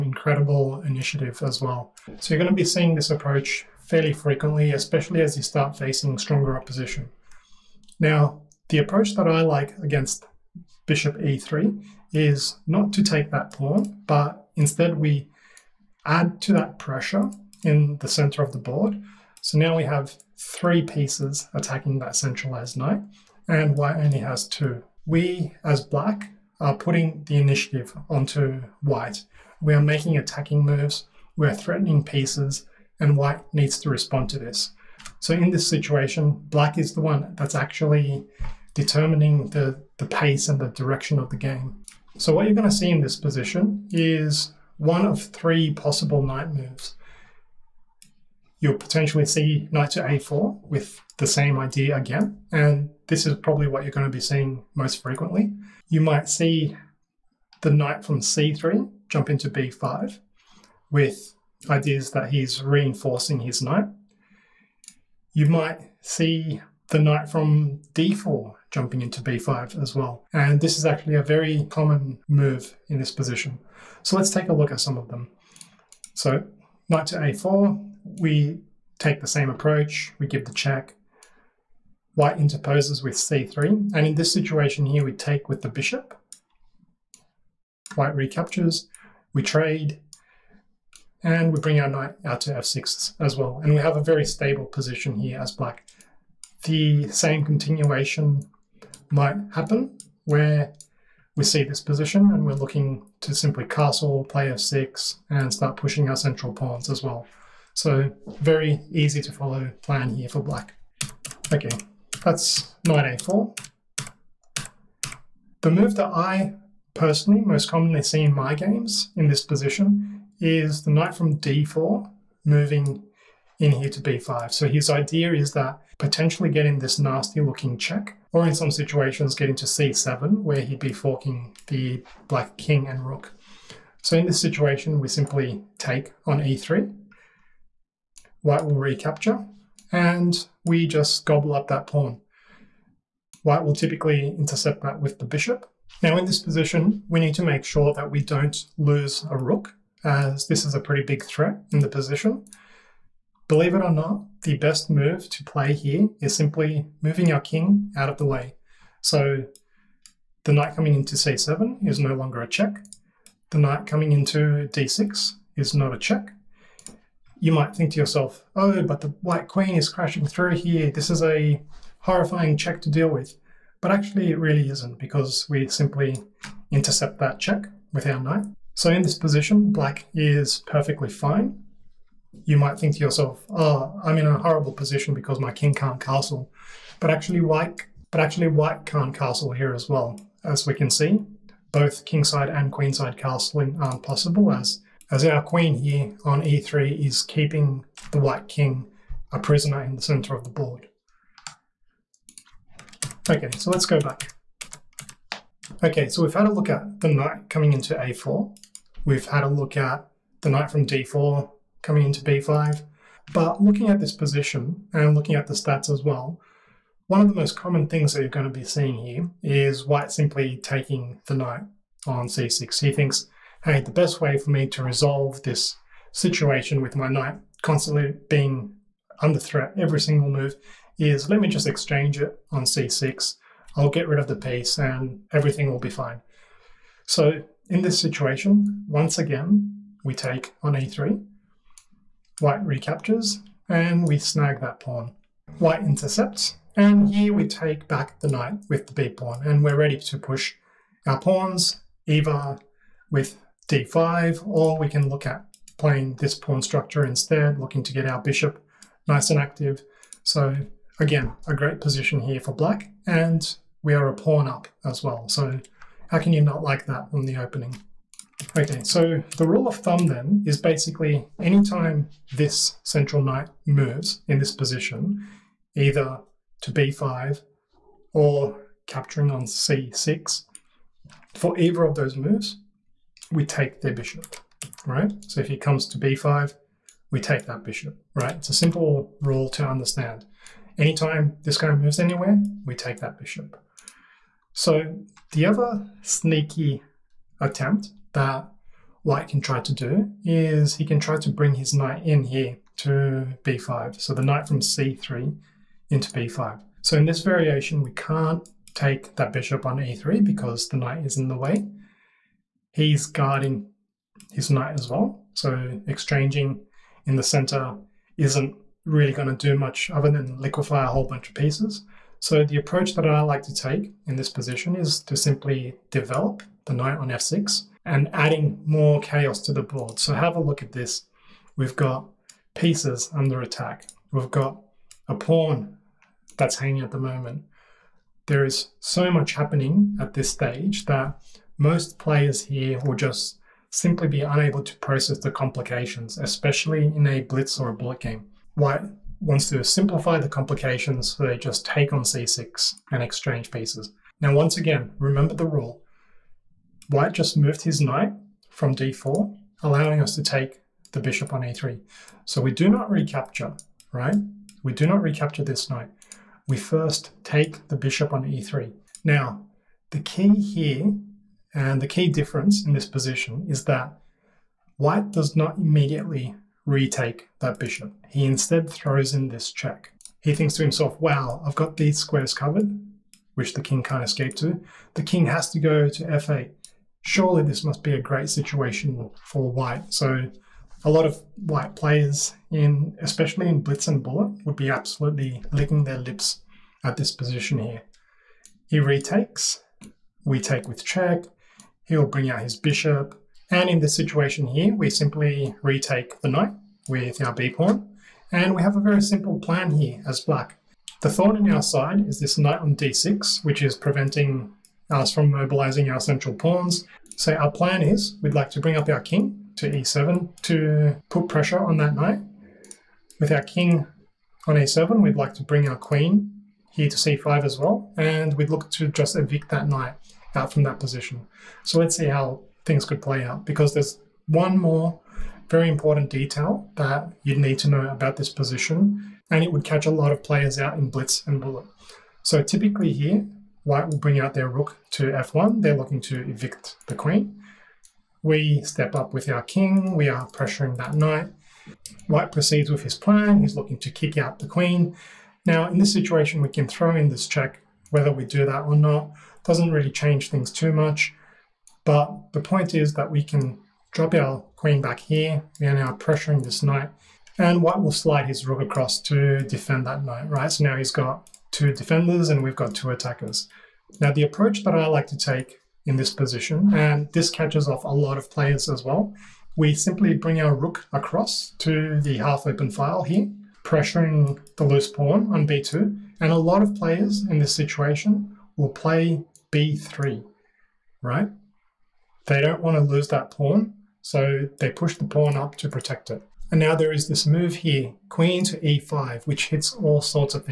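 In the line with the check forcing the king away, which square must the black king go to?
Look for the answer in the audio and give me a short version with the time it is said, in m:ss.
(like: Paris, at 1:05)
f8, at 6:26.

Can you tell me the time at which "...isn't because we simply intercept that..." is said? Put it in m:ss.
2:54.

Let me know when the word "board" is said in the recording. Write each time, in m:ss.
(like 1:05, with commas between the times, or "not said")
0:18, 3:20, 5:29.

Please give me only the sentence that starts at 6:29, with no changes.
So a lot of white players, in especially in blitz and bullet, would be absolutely licking their lips at this position here.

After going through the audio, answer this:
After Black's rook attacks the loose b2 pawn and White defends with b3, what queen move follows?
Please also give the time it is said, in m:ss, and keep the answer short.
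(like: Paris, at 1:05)
Queen to e5, at 8:18.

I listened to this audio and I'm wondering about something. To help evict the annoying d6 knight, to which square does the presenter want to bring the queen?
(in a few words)
c5.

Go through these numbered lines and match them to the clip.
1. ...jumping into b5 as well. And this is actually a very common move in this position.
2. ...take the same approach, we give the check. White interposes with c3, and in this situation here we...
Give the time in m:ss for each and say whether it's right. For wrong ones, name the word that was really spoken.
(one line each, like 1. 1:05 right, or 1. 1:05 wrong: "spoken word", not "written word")
1. 1:08 right
2. 1:18 right.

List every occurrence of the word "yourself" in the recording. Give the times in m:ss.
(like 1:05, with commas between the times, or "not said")
2:48, 3:03.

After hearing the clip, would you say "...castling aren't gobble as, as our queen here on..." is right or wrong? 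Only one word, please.
wrong.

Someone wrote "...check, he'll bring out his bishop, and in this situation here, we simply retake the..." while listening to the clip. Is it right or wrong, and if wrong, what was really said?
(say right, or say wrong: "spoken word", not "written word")
right.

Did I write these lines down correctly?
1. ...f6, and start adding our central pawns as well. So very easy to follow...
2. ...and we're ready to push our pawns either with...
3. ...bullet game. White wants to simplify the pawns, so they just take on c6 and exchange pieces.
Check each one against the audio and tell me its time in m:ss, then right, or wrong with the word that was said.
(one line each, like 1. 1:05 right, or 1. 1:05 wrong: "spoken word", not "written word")
1. 1:44 wrong: "pushing", not "adding"
2. 4:09 right
3. 5:47 wrong: "complications", not "pawns".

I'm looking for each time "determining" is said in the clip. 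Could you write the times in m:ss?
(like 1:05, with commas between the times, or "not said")
0:38.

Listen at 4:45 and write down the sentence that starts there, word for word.
So if he comes to b5, we take that bishop, right?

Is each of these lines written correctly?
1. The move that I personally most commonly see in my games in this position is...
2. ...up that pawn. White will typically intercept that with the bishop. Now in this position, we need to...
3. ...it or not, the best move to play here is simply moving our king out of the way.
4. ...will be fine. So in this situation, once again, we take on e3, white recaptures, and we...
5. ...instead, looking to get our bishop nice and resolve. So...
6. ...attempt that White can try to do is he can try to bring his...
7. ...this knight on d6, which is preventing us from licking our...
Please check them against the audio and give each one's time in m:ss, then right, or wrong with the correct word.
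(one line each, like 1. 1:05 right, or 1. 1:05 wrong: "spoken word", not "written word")
1. 1:55 right
2. 2:21 right
3. 2:33 right
4. 3:55 right
5. 4:17 wrong: "active", not "resolve"
6. 4:57 right
7. 6:52 wrong: "mobilizing", not "licking".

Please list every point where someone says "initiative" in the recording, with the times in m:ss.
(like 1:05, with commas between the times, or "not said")
0:00, 0:27.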